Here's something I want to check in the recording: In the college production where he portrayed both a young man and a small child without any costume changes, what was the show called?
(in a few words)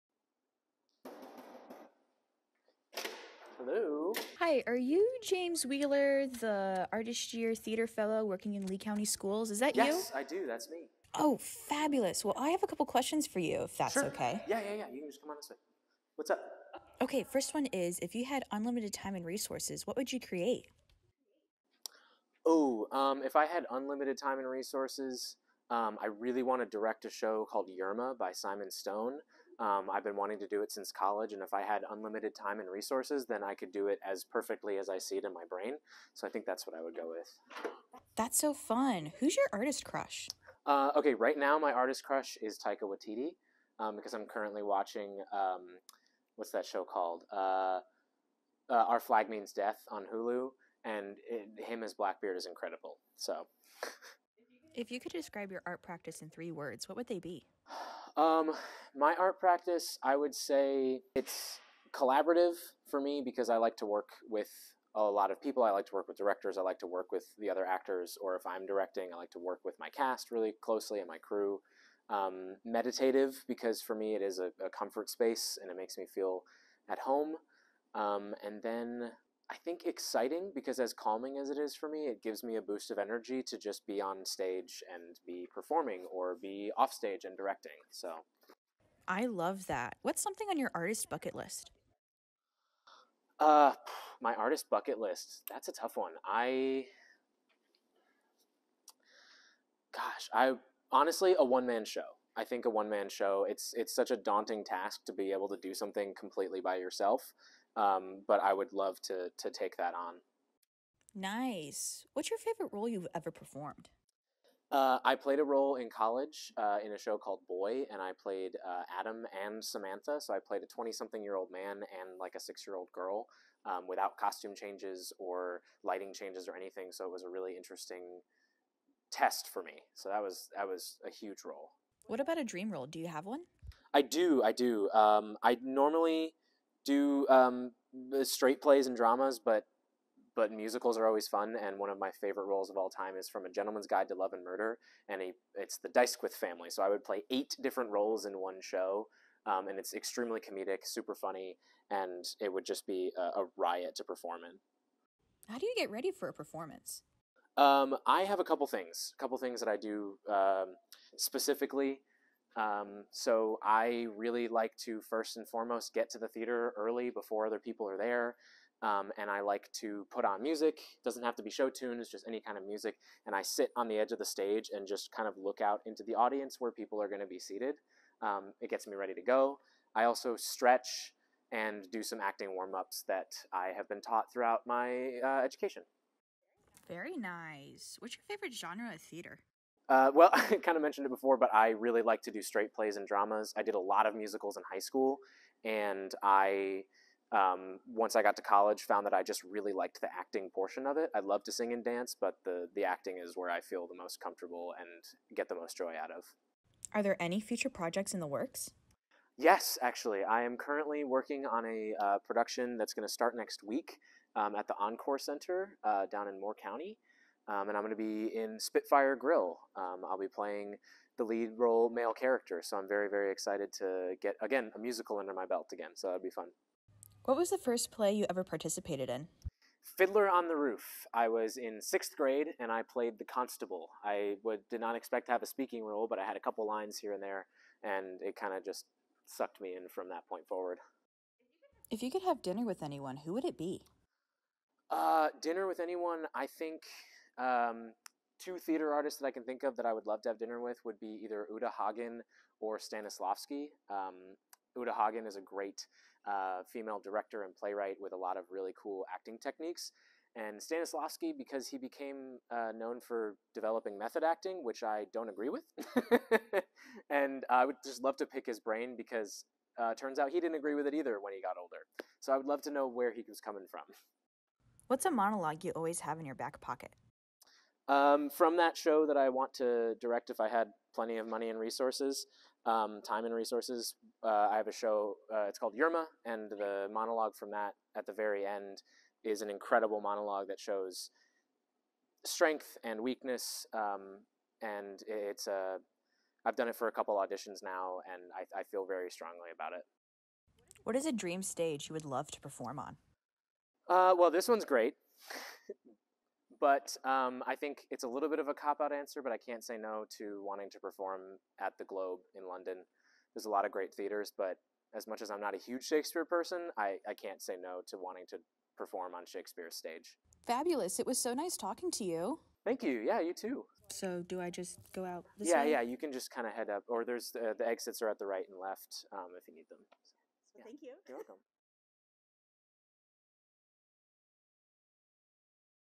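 Boy.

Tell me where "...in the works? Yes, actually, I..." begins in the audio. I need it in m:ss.
3:28.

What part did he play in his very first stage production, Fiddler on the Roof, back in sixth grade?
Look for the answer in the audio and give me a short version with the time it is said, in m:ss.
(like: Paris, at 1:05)
The constable, at 3:53.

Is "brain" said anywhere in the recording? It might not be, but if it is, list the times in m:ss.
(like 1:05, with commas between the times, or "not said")
0:35, 4:28.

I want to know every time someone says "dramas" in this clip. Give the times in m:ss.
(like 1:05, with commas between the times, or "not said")
2:18, 3:13.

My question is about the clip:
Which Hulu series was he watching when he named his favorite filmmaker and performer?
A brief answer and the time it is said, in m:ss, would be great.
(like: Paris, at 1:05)
Our Flag Means Death, at 0:48.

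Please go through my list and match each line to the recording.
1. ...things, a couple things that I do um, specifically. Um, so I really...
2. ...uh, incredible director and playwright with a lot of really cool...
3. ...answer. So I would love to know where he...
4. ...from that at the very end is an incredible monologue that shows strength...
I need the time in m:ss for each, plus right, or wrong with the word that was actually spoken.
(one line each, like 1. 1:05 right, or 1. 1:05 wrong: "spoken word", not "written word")
1. 2:38 right
2. 4:16 wrong: "female", not "incredible"
3. 4:31 wrong: "older", not "answer"
4. 4:47 right.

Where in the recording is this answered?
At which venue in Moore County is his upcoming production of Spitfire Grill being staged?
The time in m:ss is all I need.
3:34.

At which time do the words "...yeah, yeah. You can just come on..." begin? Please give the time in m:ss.
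0:14.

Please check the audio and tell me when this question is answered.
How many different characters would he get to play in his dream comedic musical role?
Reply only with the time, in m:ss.
2:27.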